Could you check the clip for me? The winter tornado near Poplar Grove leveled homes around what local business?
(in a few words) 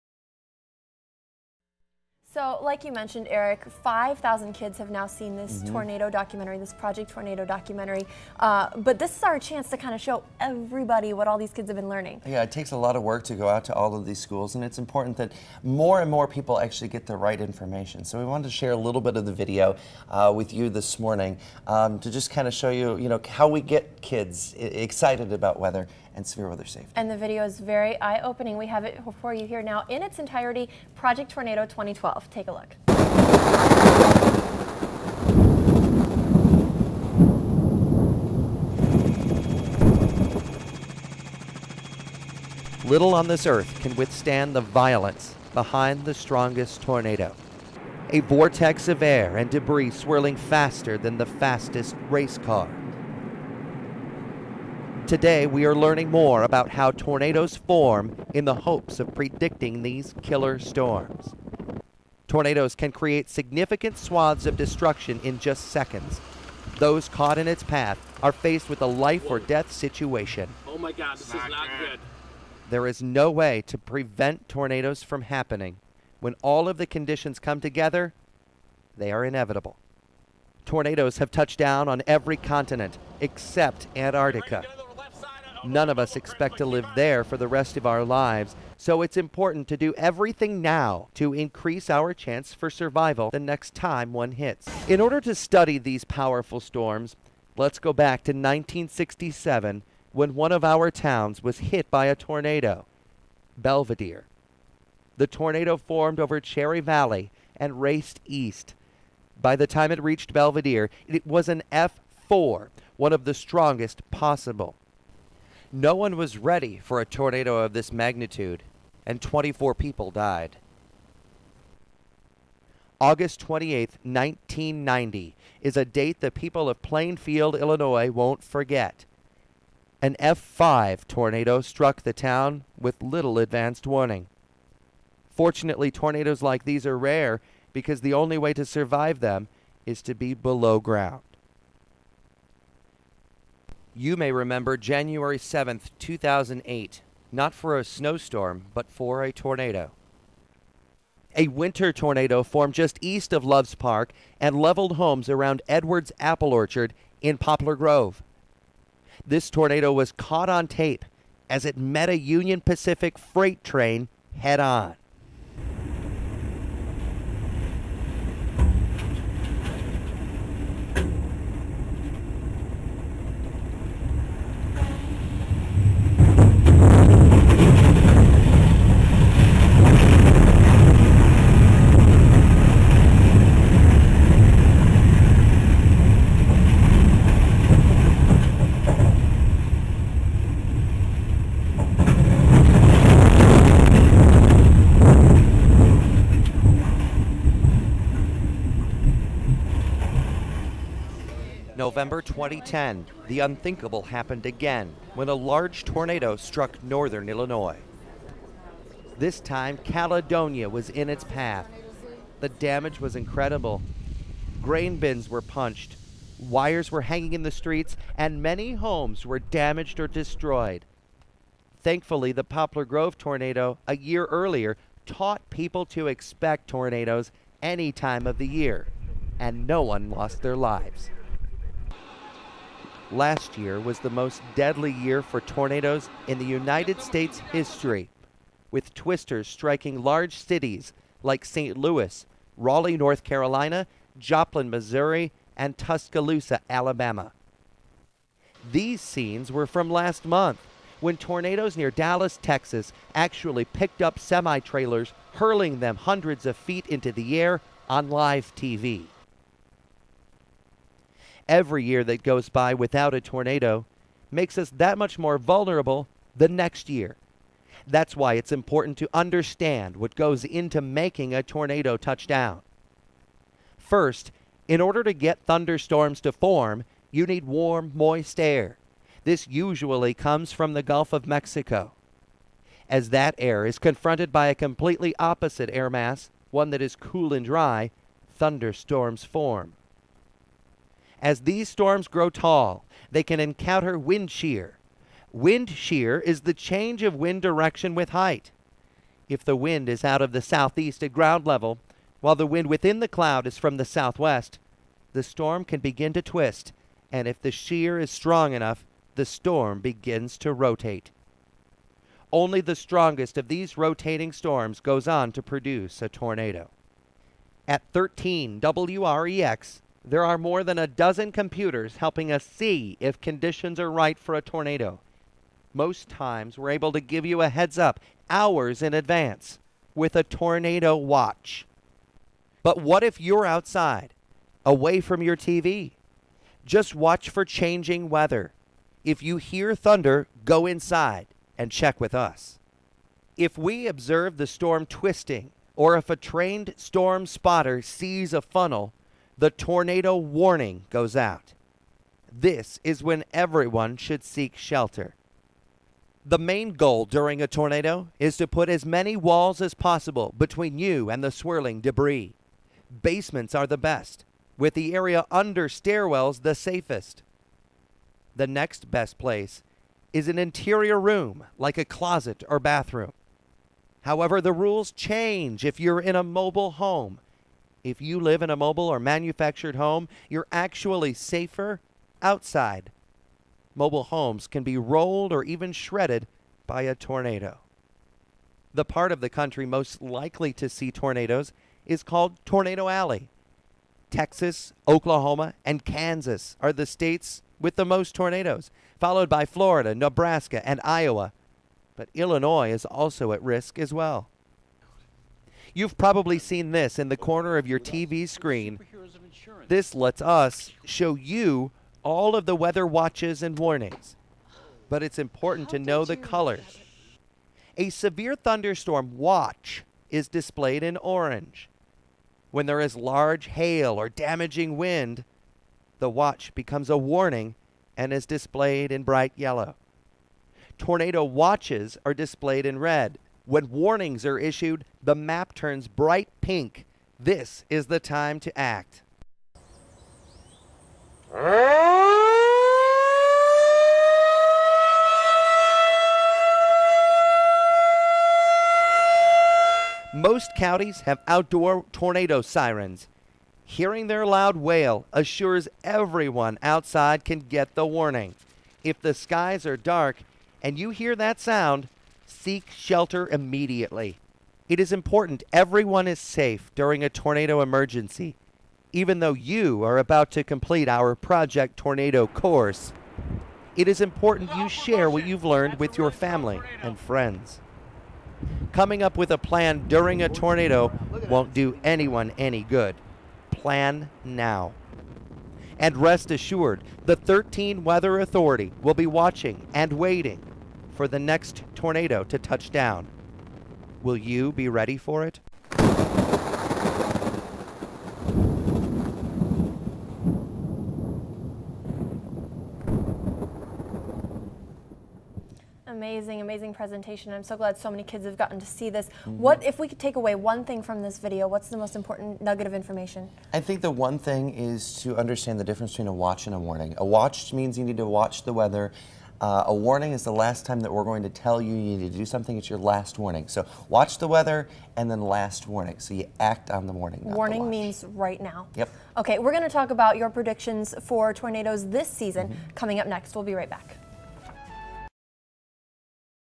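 Edwards Apple Orchard.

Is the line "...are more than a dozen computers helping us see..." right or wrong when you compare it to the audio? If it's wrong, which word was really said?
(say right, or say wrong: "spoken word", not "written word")
right.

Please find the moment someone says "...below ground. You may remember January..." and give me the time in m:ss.
2:20.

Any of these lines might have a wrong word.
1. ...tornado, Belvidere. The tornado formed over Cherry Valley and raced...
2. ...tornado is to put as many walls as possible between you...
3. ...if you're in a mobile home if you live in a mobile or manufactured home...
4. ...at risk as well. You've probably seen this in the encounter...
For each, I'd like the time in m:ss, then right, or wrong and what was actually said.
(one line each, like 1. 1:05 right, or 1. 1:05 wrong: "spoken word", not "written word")
1. 1:42 right
2. 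5:57 right
3. 6:15 right
4. 6:43 wrong: "corner", not "encounter".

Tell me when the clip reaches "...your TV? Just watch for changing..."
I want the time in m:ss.
5:35.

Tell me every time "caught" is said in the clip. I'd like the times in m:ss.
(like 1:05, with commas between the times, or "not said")
1:07, 2:40.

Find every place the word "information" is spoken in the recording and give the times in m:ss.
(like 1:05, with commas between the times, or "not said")
0:17, 8:32.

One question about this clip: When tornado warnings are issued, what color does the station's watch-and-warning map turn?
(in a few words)
bright pink.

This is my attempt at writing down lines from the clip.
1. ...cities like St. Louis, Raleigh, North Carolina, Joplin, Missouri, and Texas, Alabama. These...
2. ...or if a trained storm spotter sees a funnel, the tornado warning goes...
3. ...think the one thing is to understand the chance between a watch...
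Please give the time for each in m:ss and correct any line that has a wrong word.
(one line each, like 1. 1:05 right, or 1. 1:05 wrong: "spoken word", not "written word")
1. 4:00 wrong: "Tuscaloosa", not "Texas"
2. 5:45 right
3. 8:33 wrong: "difference", not "chance".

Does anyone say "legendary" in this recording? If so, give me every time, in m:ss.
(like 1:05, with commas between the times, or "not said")
not said.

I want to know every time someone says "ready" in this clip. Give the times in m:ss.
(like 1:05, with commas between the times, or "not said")
1:56, 8:14.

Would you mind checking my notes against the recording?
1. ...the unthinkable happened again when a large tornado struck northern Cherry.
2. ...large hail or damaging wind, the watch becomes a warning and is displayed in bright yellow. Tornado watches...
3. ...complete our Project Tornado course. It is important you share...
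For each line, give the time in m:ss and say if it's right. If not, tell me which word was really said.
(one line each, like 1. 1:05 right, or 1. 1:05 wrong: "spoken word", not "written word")
1. 3:23 wrong: "Illinois", not "Cherry"
2. 7:02 right
3. 7:50 right.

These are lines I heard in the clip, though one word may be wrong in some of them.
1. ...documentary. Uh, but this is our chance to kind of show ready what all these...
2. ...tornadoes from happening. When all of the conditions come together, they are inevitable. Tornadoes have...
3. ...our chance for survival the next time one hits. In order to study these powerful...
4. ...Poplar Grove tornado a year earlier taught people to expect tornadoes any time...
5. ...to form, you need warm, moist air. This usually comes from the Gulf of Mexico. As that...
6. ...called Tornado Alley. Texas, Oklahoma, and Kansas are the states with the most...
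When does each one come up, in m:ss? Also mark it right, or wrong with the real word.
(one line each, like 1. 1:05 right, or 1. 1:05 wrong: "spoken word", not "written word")
1. 0:07 wrong: "everybody", not "ready"
2. 1:14 right
3. 1:31 right
4. 3:42 right
5. 4:36 right
6. 6:32 right.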